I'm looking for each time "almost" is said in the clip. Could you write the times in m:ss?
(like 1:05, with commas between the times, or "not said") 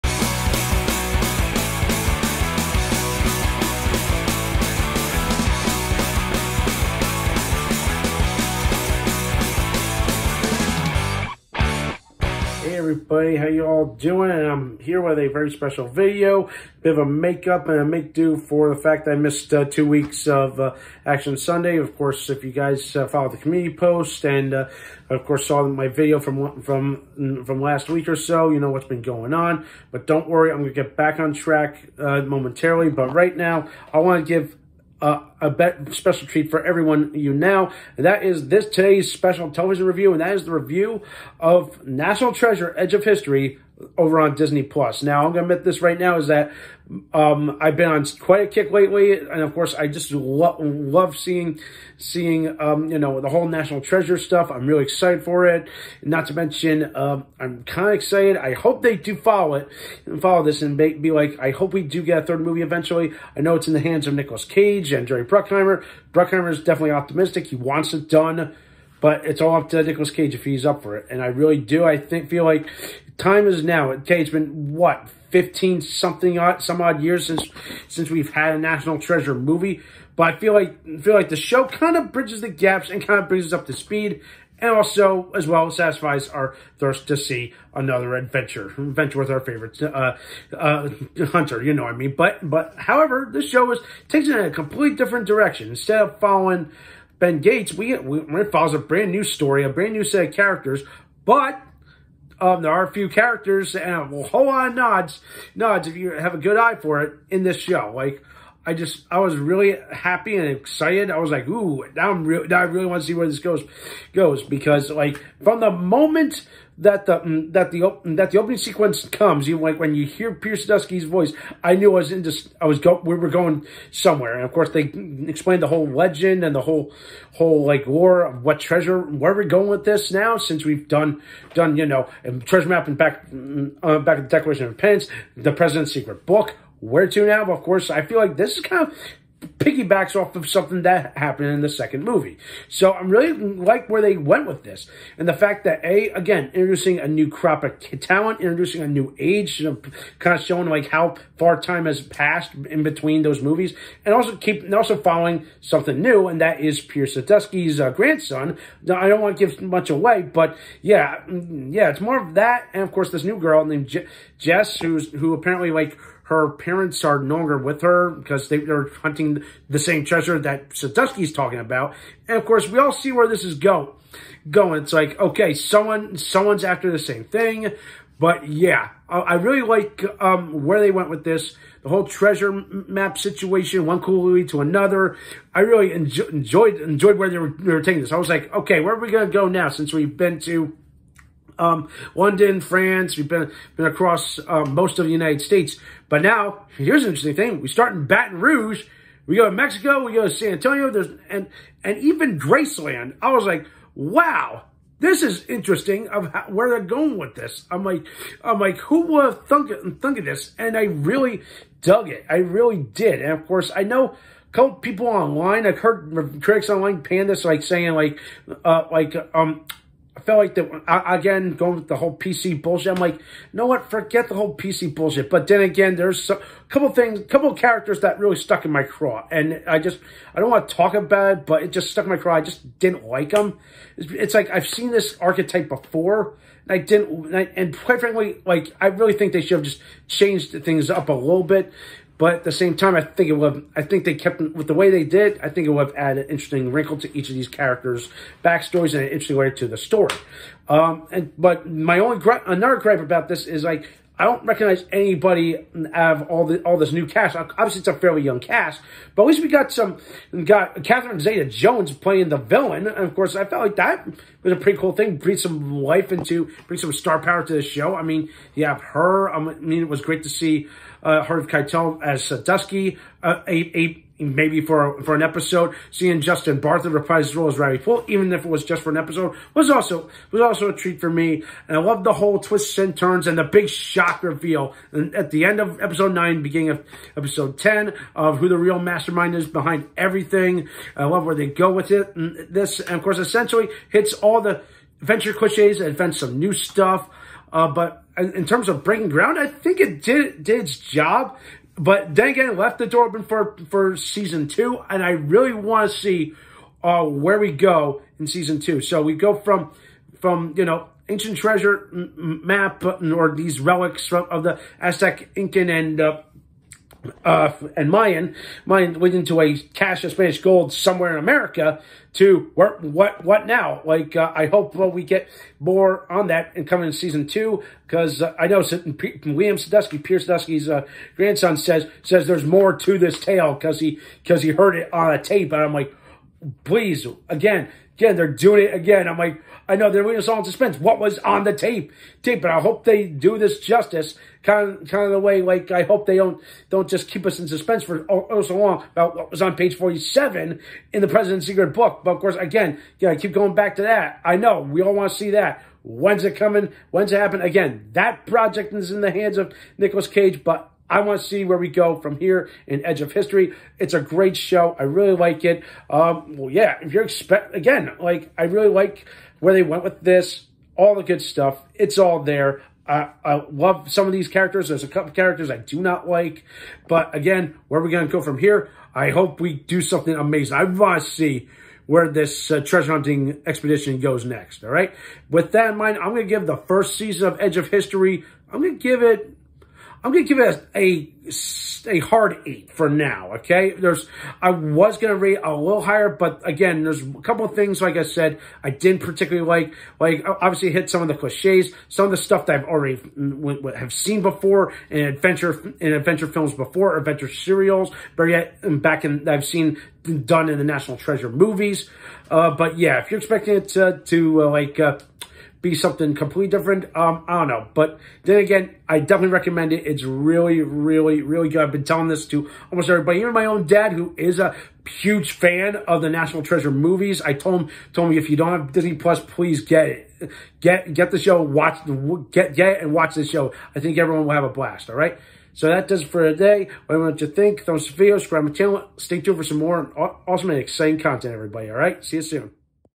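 7:02.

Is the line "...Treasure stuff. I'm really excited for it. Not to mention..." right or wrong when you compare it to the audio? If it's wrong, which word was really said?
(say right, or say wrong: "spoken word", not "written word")
right.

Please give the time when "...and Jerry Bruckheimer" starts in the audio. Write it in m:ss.
1:04.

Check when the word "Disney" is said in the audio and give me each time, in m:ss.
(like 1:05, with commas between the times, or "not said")
0:44, 7:08.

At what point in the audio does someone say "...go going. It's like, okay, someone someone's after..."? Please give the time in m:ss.
2:53.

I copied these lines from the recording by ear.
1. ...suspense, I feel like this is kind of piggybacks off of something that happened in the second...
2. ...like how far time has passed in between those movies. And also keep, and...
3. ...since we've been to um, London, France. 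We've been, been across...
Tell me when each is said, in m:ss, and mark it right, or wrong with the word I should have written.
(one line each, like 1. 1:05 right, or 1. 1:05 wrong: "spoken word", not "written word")
1. 2:17 wrong: "course", not "suspense"
2. 2:30 right
3. 3:09 right.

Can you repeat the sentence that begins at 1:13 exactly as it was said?
Okay, it's been, what, 15 something odd, some odd years since since we've had a National Treasure movie.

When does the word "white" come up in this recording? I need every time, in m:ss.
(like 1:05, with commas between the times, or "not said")
not said.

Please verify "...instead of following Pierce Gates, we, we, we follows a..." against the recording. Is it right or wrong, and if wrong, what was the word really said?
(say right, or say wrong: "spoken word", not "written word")
wrong: "Ben", not "Pierce".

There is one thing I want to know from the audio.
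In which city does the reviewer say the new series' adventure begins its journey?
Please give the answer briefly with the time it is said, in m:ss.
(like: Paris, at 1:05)
Baton Rouge, at 3:18.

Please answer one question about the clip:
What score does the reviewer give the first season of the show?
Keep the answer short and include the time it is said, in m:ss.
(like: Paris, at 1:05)
8, at 6:31.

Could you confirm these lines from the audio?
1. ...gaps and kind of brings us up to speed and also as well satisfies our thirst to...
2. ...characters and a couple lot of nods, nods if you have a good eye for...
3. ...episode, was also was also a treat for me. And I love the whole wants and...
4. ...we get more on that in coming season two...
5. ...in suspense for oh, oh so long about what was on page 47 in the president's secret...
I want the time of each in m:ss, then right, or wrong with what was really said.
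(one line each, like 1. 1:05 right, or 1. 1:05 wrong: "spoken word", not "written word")
1. 1:22 right
2. 1:43 wrong: "whole", not "couple"
3. 4:38 wrong: "twists", not "wants"
4. 5:24 right
5. 5:47 right.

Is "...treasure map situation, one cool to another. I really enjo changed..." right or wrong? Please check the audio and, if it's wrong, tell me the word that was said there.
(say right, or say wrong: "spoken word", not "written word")
wrong: "enjoyed", not "changed".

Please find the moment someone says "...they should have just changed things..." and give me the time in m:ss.
3:59.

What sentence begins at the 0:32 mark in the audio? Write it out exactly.
But right now, I want to give uh, a special treat for everyone you now.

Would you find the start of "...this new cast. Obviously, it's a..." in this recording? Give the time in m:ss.
4:16.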